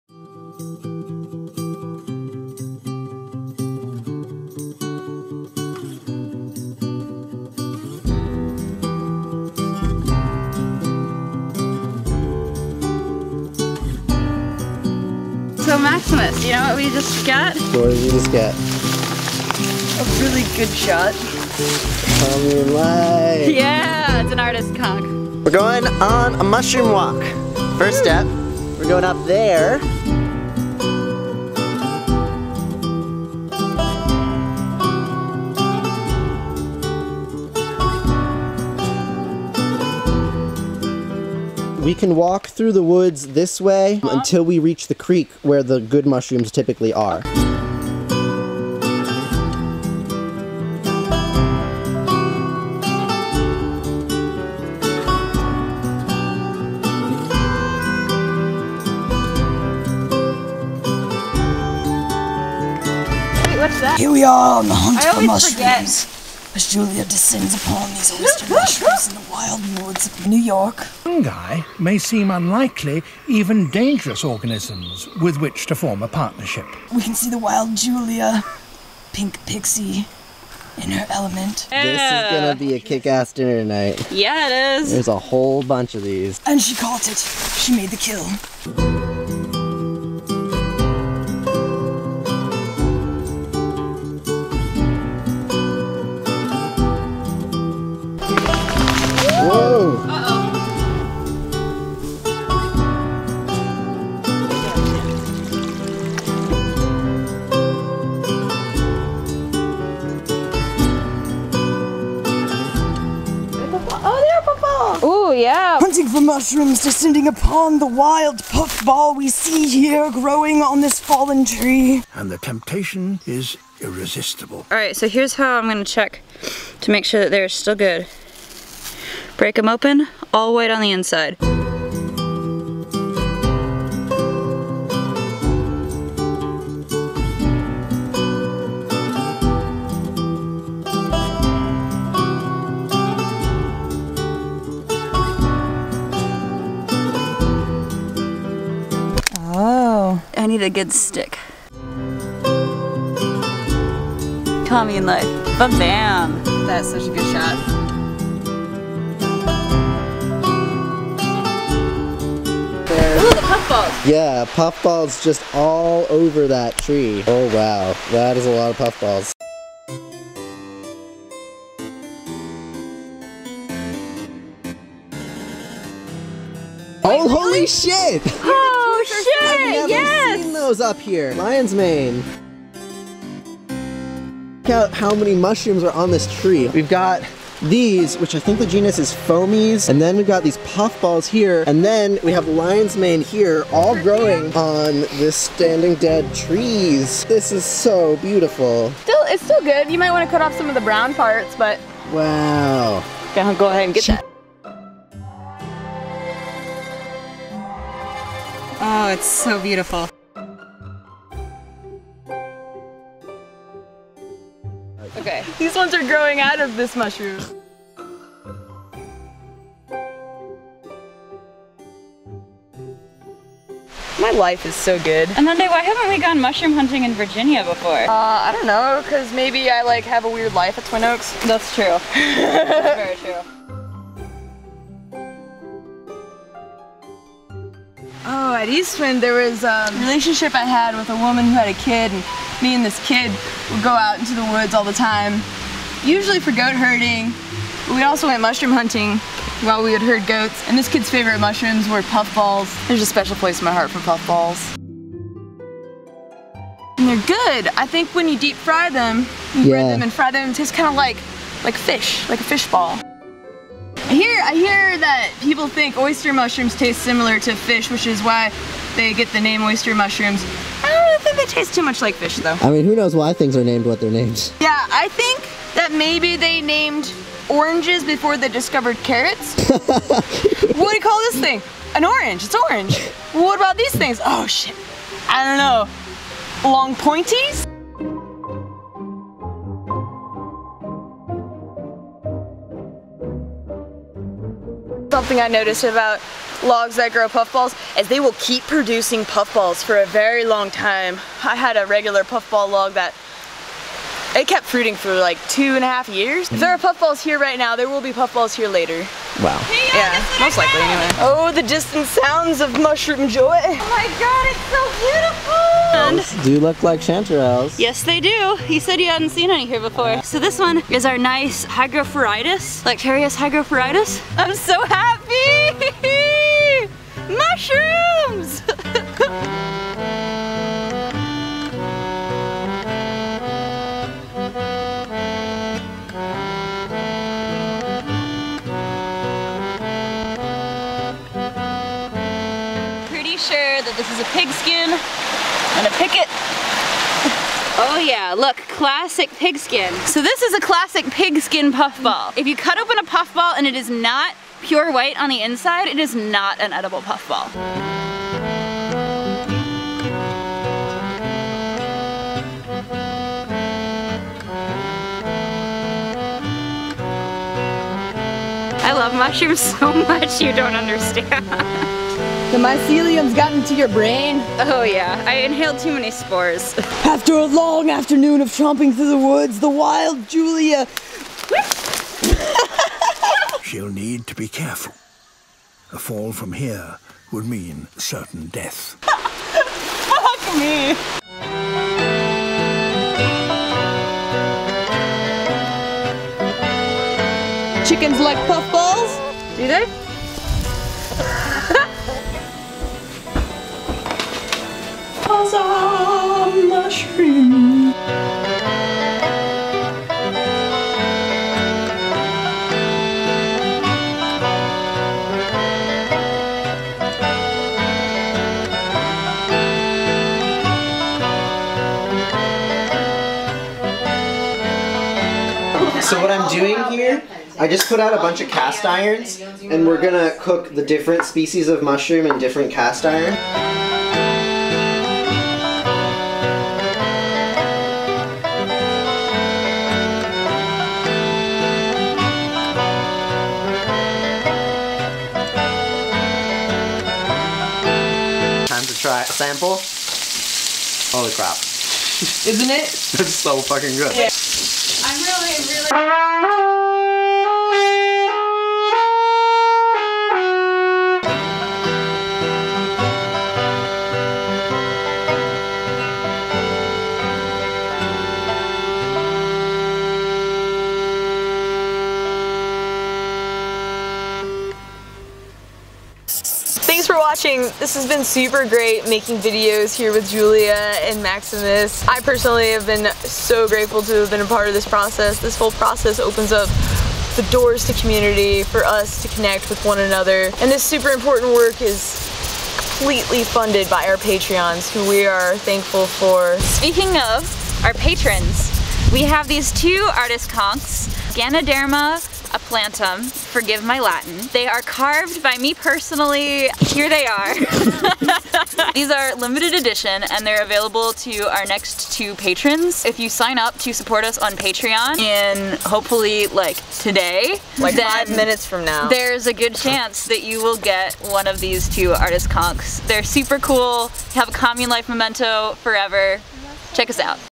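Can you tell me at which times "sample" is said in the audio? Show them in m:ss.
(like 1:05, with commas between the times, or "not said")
7:29.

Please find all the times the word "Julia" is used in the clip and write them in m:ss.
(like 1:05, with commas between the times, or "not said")
1:06, 1:17, 6:20, 8:00.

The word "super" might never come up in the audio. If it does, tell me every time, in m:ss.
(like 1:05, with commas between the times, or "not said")
7:58, 8:10, 8:43.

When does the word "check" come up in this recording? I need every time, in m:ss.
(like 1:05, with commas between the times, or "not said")
2:05, 8:46.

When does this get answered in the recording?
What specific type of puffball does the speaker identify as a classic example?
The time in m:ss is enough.
5:51.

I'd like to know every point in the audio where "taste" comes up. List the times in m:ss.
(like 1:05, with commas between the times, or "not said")
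4:20, 4:26, 4:31.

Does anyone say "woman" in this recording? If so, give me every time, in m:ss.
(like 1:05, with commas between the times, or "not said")
4:01.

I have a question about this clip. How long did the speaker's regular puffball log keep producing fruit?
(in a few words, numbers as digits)
2.5 years.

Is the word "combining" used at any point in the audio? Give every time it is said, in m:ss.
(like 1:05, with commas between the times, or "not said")
not said.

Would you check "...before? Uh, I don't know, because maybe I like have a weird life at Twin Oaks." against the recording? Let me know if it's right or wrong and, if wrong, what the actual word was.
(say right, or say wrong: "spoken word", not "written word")
right.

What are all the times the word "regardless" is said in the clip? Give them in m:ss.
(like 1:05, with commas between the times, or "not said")
not said.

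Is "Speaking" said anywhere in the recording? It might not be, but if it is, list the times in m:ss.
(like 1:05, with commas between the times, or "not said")
8:16.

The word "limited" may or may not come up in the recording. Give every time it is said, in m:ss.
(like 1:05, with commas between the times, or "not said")
8:29.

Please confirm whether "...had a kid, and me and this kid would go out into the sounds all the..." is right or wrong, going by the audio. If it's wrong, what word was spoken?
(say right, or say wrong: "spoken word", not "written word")
wrong: "woods", not "sounds".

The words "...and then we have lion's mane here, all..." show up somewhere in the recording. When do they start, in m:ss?
3:11.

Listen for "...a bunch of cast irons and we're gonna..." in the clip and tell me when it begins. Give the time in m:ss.
7:08.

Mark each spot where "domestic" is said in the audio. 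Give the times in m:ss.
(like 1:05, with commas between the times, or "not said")
not said.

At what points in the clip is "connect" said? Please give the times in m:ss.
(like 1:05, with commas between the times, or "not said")
8:09.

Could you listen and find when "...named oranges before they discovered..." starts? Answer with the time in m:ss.
4:36.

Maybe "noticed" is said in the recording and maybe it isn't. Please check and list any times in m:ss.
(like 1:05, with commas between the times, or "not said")
4:55.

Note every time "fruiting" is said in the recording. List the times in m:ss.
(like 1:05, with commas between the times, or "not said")
5:04.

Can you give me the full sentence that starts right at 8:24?
They are carved by me personally.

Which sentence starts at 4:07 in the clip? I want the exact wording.
We also went mushroom hunting while we would herd goats, and this kid's favorite mushrooms were puffballs.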